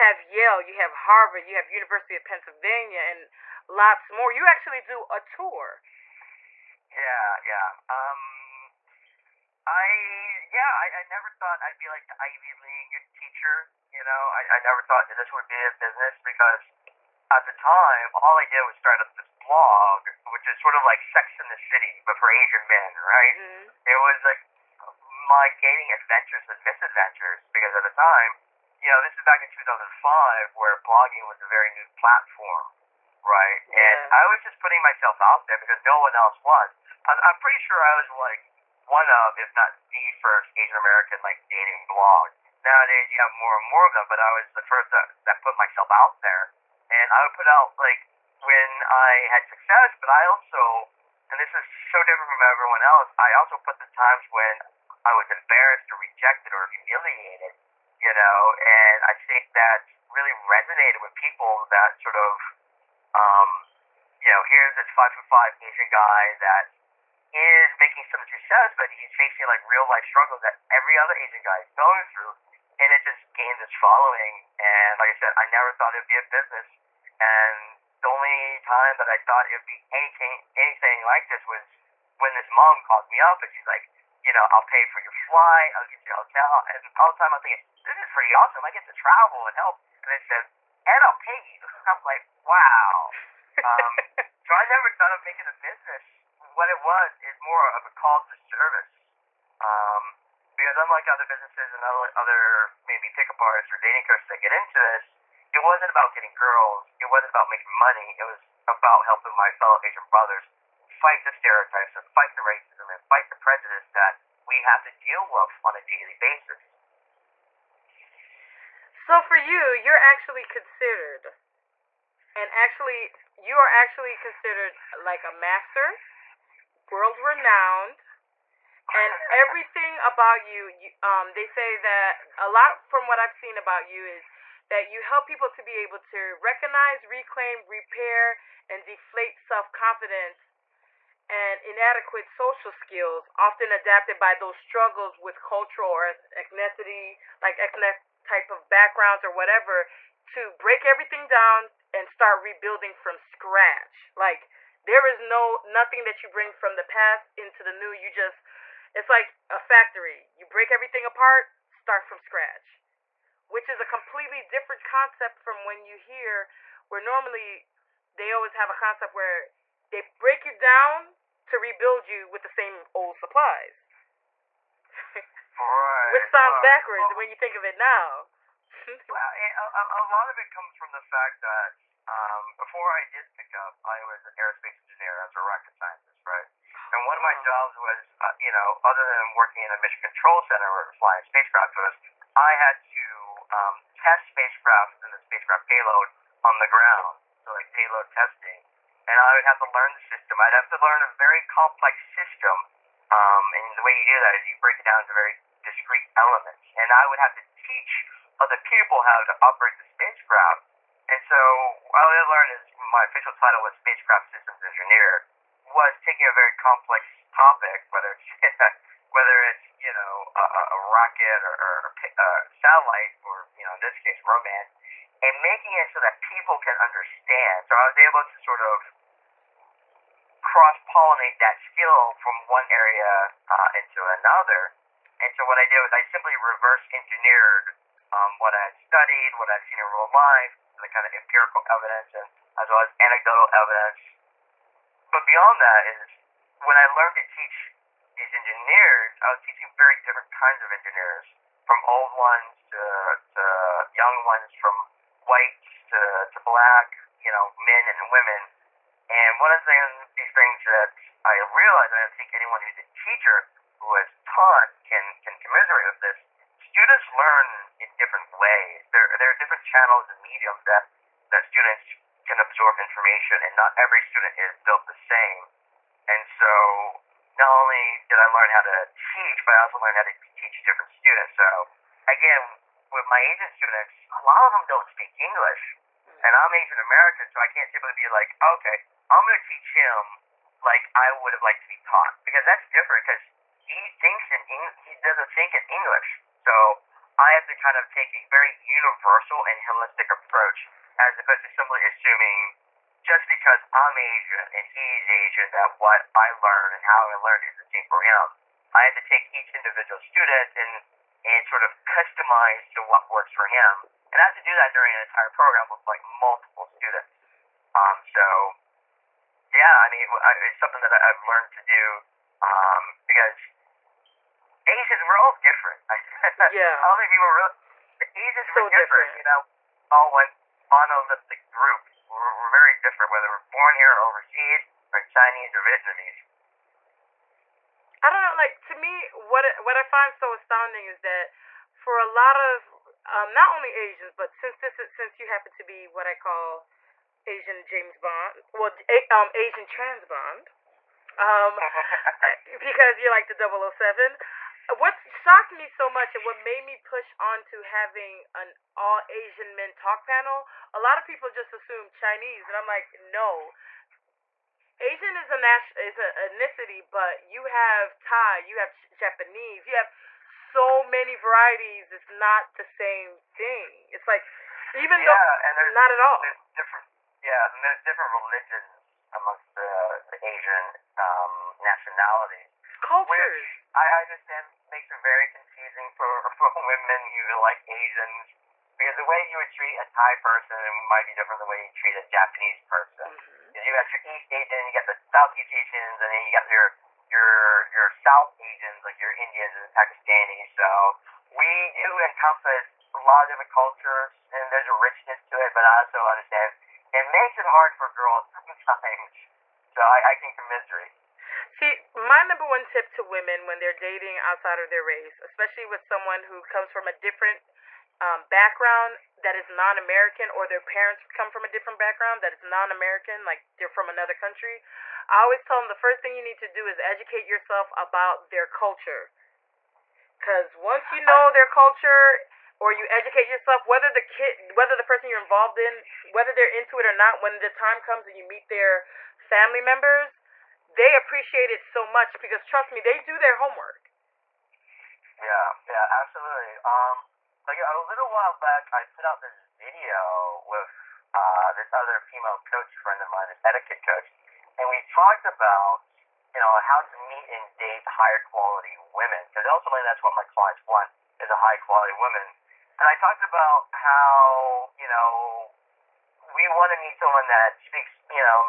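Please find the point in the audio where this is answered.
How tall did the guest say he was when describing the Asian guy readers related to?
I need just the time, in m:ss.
1:04.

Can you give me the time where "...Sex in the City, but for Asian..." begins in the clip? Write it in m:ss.
0:21.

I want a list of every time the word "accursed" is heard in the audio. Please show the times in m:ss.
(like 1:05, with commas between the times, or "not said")
not said.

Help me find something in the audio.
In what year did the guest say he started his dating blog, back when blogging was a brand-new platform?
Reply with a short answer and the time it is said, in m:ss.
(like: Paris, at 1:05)
2005, at 0:29.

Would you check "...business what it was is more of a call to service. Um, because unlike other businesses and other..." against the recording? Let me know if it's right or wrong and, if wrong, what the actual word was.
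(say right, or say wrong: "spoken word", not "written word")
right.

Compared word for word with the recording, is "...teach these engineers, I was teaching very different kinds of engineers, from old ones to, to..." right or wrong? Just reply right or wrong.
right.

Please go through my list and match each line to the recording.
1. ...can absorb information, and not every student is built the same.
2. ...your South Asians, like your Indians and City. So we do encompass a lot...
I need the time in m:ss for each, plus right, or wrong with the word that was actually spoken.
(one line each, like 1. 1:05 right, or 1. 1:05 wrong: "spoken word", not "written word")
1. 4:32 right
2. 6:37 wrong: "Pakistanis", not "City".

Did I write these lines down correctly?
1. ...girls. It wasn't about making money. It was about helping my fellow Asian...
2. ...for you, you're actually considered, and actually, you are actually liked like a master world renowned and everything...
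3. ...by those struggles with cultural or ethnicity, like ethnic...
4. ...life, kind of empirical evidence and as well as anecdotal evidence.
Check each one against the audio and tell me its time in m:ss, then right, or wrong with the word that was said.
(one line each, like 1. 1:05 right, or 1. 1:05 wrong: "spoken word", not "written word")
1. 1:46 right
2. 1:59 wrong: "considered", not "liked"
3. 2:24 right
4. 4:00 right.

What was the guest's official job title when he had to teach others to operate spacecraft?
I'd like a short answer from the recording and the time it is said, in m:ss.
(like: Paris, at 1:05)
Spacecraft systems engineer, at 3:33.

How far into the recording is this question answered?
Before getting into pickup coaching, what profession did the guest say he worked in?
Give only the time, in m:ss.
3:04.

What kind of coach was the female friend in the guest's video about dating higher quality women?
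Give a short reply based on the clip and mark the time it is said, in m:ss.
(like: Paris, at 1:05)
Etiquette coach, at 7:33.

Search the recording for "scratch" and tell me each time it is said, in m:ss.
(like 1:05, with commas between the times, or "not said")
2:33, 2:42.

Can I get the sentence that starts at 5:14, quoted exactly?
And I have to do that during an entire program with like multiple students.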